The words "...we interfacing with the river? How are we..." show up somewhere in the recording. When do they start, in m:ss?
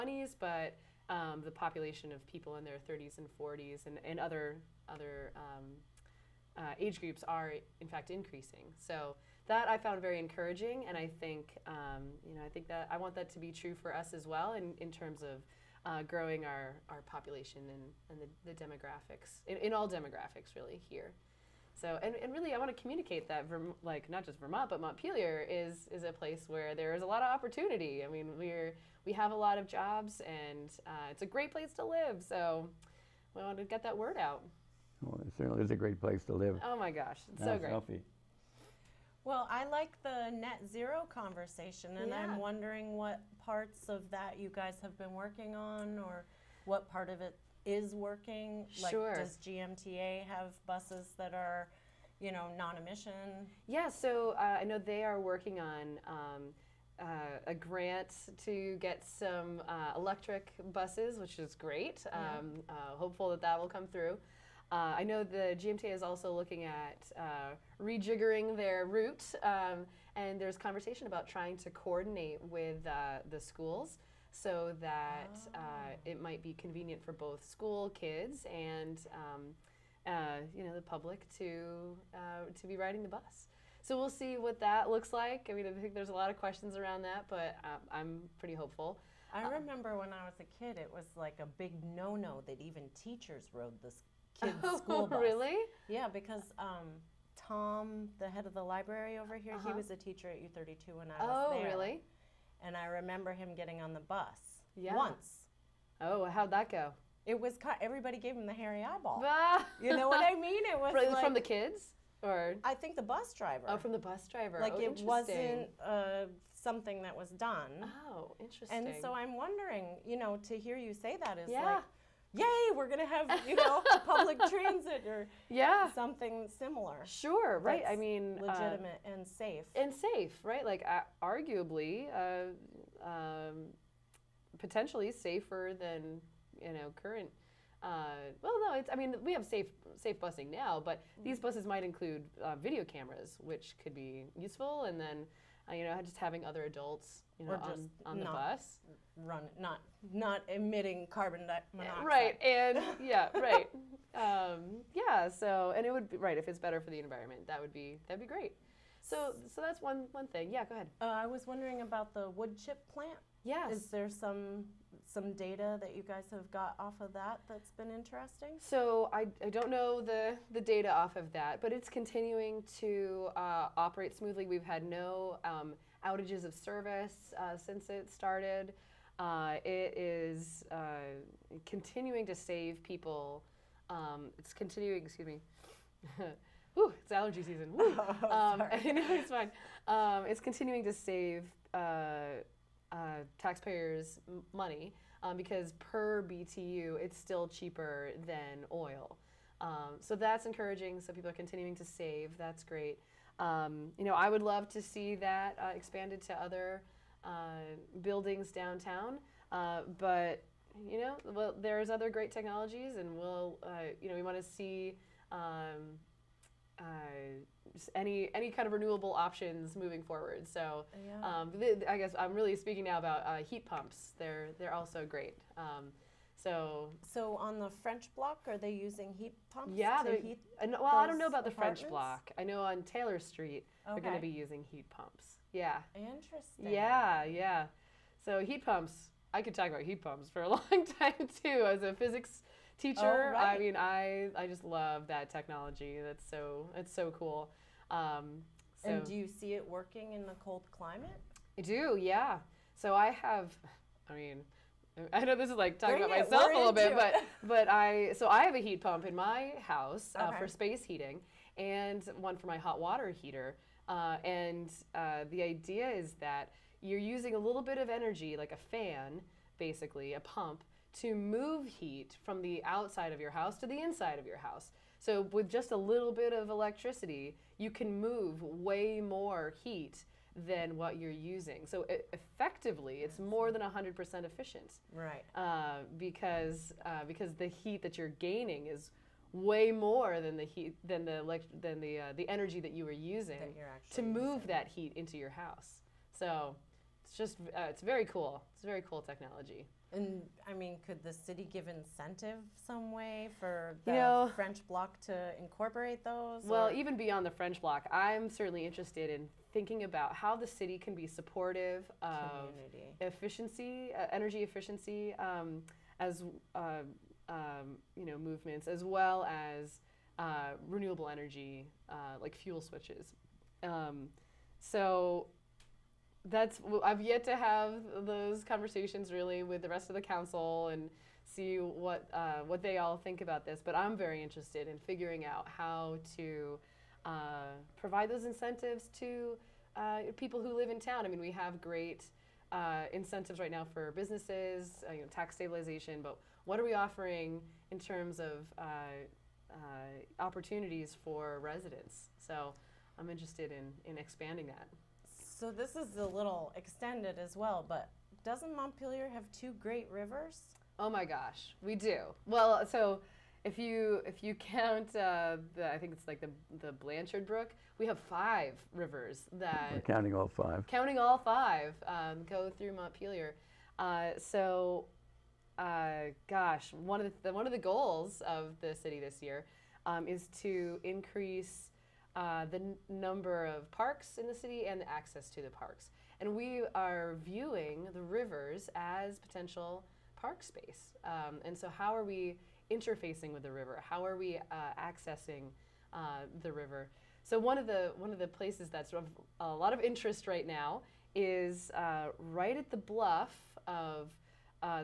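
6:32.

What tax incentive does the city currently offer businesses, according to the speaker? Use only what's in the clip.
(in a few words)
tax stabilization.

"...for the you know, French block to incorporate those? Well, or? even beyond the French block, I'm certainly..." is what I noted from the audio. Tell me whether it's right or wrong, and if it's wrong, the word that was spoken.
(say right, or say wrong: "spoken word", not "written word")
right.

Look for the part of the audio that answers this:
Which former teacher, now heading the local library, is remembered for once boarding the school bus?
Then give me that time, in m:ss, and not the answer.
1:37.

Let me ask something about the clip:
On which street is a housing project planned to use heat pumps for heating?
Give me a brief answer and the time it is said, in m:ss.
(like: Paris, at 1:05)
Taylor Street, at 3:52.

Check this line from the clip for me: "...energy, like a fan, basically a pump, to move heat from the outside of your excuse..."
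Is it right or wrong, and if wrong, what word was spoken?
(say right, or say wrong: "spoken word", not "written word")
wrong: "house", not "excuse".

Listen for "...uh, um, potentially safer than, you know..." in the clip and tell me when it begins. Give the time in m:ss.
2:12.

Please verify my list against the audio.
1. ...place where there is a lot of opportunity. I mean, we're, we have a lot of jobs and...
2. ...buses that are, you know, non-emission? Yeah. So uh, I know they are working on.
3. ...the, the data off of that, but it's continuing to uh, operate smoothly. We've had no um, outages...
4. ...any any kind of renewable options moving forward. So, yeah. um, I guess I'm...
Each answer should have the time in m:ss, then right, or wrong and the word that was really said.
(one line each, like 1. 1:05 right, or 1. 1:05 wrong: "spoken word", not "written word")
1. 0:26 right
2. 0:50 right
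3. 2:50 right
4. 3:37 right.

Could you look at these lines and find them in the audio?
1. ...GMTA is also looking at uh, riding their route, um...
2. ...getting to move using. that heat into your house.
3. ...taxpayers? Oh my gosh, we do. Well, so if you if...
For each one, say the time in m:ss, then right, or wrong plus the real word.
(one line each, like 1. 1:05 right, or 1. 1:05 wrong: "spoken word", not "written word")
1. 1:05 wrong: "rejiggering", not "riding"
2. 4:52 wrong: "using", not "getting"
3. 5:59 wrong: "rivers", not "taxpayers".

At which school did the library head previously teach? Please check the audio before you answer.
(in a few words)
U32.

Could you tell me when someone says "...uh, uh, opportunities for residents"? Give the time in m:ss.
5:48.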